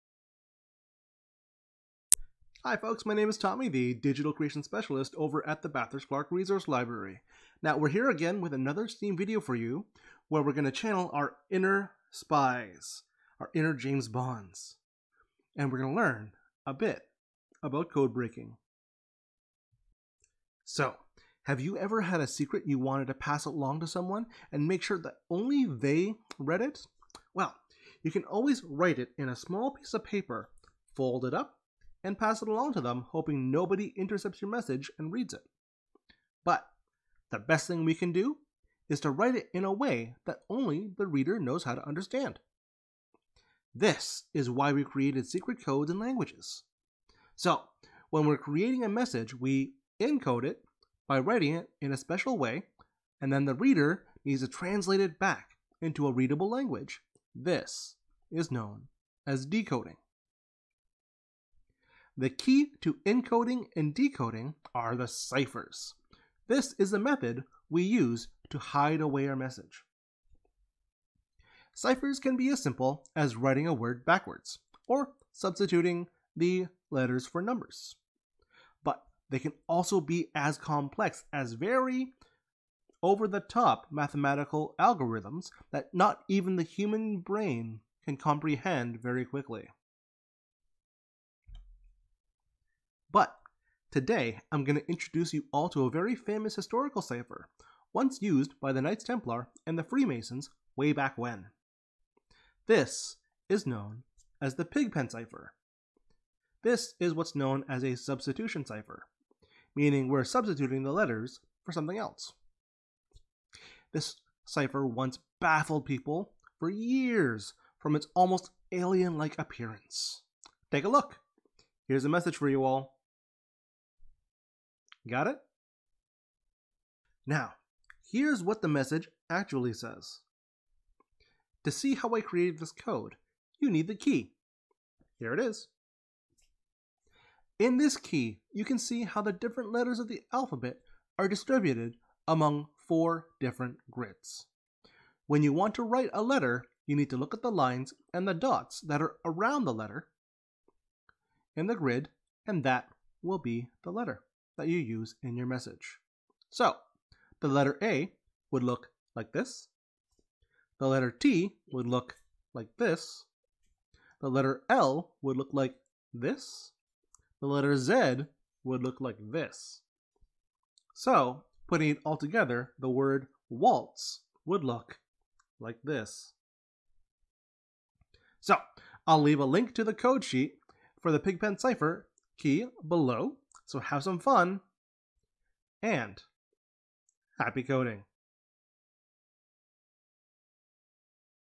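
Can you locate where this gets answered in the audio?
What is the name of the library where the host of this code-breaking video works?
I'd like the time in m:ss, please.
0:05.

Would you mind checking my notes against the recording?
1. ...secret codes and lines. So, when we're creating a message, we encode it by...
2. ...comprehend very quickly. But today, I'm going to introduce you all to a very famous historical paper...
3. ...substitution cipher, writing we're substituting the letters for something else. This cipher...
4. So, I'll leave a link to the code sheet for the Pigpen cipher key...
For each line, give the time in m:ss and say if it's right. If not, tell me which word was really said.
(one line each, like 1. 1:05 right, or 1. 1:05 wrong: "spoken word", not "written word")
1. 0:45 wrong: "languages", not "lines"
2. 1:28 wrong: "cipher", not "paper"
3. 1:47 wrong: "meaning", not "writing"
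4. 2:58 right.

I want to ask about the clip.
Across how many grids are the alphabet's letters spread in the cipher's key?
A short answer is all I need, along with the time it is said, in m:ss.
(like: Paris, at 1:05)
4, at 2:22.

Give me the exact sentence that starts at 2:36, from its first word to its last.
So, the letter A would look like this.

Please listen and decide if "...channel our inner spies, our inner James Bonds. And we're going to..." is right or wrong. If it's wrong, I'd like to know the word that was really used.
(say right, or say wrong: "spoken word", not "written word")
right.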